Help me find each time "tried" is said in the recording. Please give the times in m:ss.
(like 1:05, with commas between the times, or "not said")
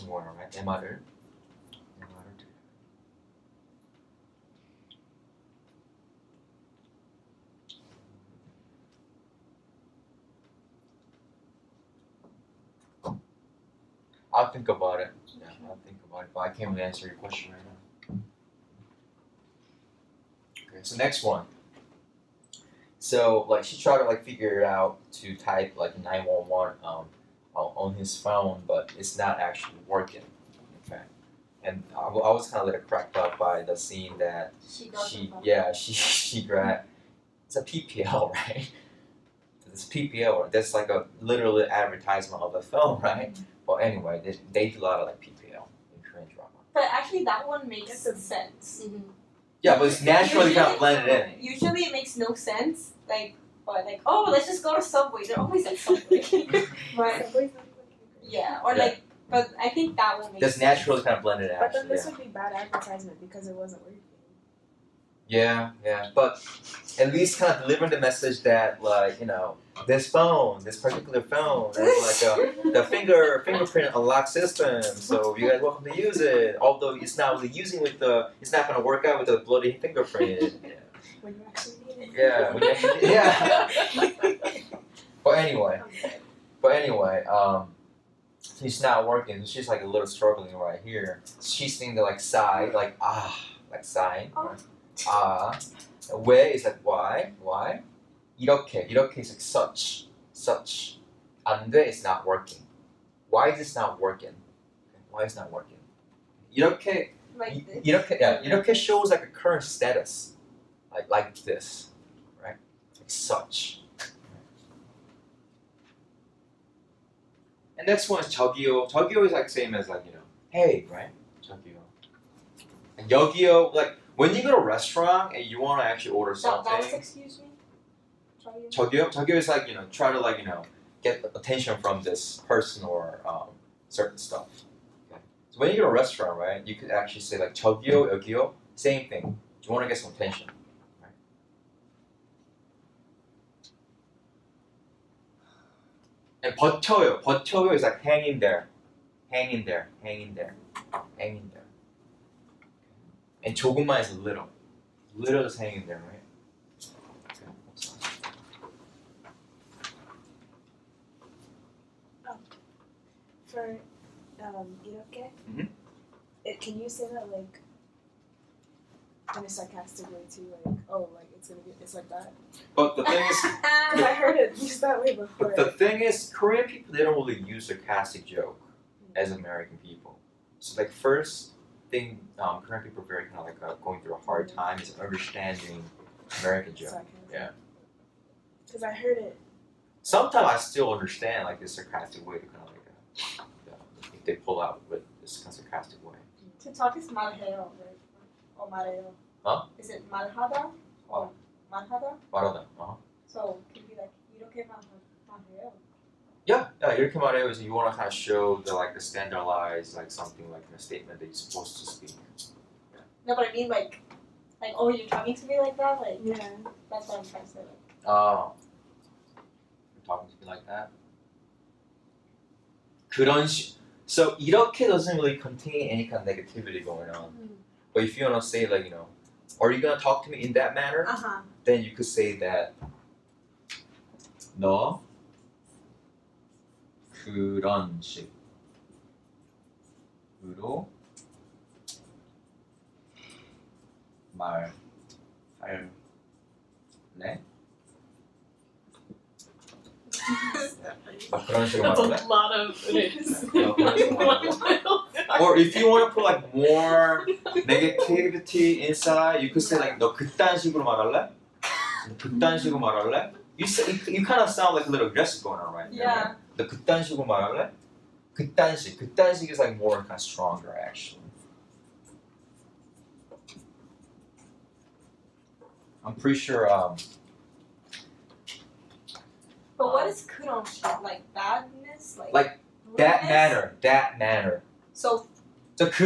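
0:23.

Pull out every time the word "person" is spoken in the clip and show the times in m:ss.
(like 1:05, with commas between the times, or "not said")
2:12.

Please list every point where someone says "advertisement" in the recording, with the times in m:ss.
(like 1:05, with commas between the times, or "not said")
0:41, 1:02.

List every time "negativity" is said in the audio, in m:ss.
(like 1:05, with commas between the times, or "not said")
3:46, 4:17.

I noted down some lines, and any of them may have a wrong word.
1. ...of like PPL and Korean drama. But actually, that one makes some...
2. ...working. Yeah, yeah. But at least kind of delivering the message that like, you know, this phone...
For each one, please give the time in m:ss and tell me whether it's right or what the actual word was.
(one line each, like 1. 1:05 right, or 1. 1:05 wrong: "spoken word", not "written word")
1. 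0:45 right
2. 1:03 right.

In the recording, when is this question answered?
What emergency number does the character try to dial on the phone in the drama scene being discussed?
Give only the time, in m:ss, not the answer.
0:26.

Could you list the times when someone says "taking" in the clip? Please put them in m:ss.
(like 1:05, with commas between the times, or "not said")
not said.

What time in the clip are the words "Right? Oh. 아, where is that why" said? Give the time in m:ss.
1:34.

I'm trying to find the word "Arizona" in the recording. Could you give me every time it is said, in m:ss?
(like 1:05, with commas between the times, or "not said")
not said.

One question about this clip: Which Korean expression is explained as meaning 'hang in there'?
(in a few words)
버텨요.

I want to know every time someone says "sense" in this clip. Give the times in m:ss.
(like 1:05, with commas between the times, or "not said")
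0:48, 0:52.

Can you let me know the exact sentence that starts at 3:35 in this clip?
Like yeah, that's what I'm trying to say.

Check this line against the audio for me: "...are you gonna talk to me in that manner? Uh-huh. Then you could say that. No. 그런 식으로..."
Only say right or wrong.
right.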